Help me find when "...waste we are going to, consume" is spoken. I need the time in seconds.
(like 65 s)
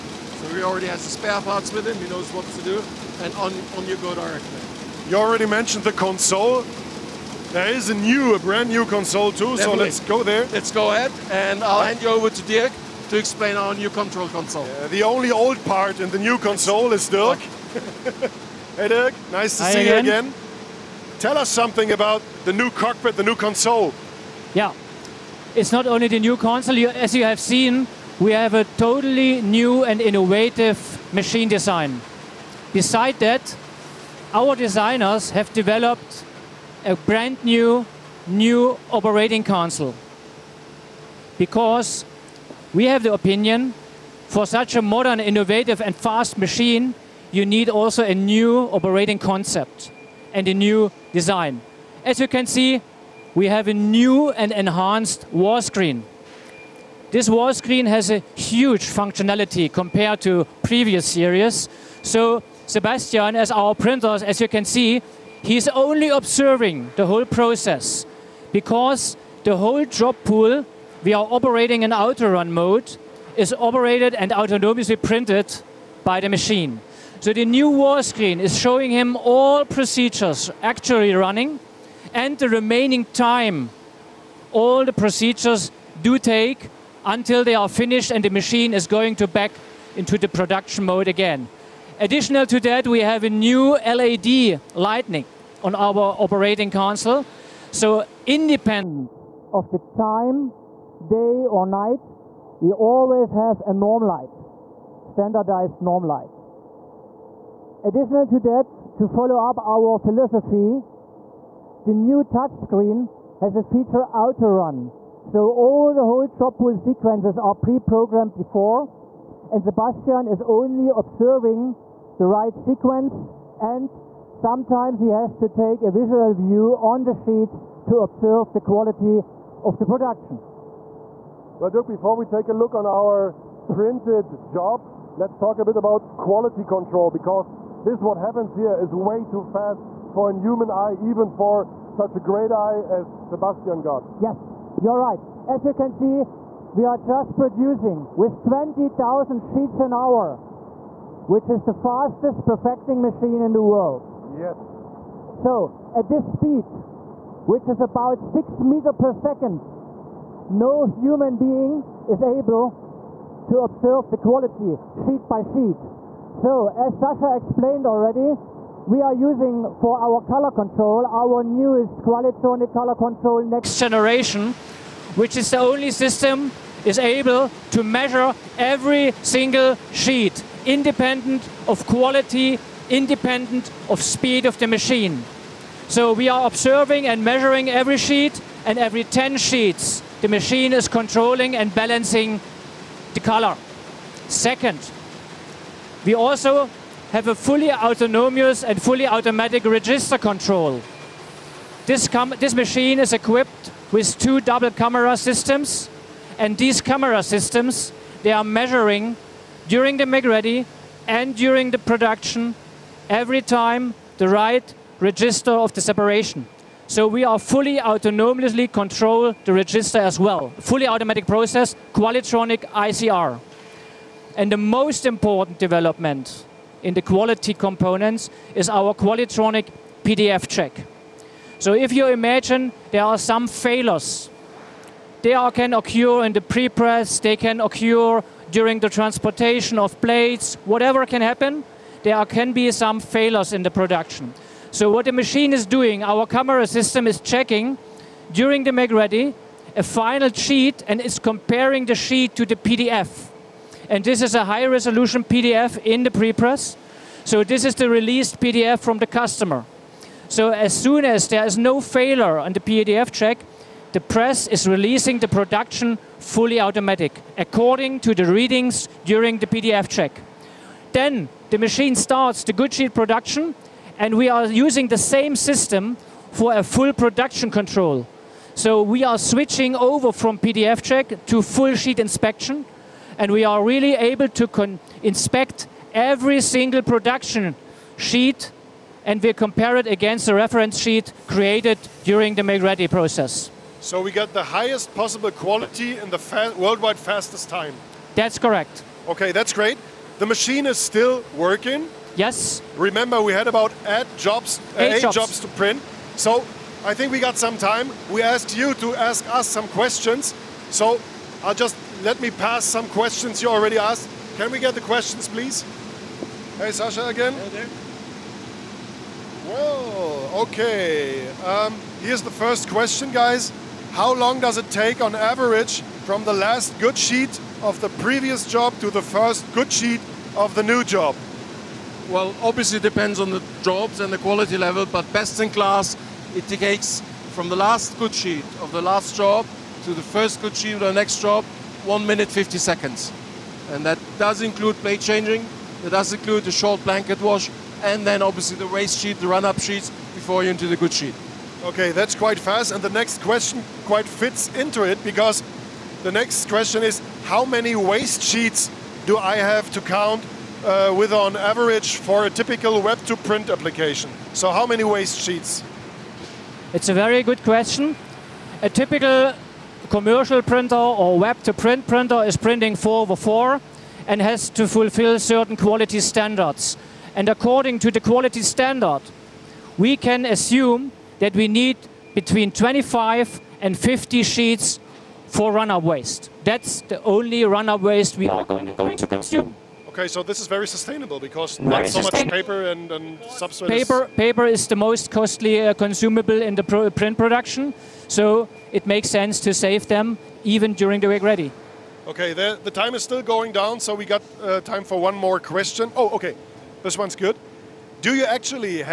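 387 s.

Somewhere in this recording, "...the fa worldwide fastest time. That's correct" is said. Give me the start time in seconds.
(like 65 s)
296 s.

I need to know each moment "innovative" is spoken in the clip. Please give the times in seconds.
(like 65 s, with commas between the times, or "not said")
30 s, 45 s.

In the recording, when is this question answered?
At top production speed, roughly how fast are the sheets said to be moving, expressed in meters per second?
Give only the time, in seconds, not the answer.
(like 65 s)
158 s.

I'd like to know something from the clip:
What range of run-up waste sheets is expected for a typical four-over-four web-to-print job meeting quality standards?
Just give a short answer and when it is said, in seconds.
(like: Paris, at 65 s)
25 to 50, at 382 s.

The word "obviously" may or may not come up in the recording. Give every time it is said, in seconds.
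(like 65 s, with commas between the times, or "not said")
332 s, 348 s.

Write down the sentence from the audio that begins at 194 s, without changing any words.
Second, we also have a fully autonomous and fully automatic register control.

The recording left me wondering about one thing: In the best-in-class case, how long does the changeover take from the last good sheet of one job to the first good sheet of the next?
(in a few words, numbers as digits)
1 minute 50 seconds.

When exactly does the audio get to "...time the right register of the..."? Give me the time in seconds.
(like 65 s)
213 s.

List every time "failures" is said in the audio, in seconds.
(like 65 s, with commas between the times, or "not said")
233 s, 243 s, 261 s.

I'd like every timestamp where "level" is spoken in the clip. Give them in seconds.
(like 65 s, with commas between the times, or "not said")
334 s.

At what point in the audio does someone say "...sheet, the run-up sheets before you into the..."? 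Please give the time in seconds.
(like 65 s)
348 s.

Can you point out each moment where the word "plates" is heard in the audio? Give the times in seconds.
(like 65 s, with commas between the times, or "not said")
240 s, 344 s.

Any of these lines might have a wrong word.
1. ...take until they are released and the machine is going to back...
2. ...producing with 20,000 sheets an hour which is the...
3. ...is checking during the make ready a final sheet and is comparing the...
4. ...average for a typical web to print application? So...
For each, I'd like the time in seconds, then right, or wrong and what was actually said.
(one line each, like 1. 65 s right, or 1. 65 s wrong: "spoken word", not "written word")
1. 86 s wrong: "finished", not "released"
2. 147 s right
3. 247 s right
4. 361 s right.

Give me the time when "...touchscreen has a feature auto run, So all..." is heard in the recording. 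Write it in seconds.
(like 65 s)
112 s.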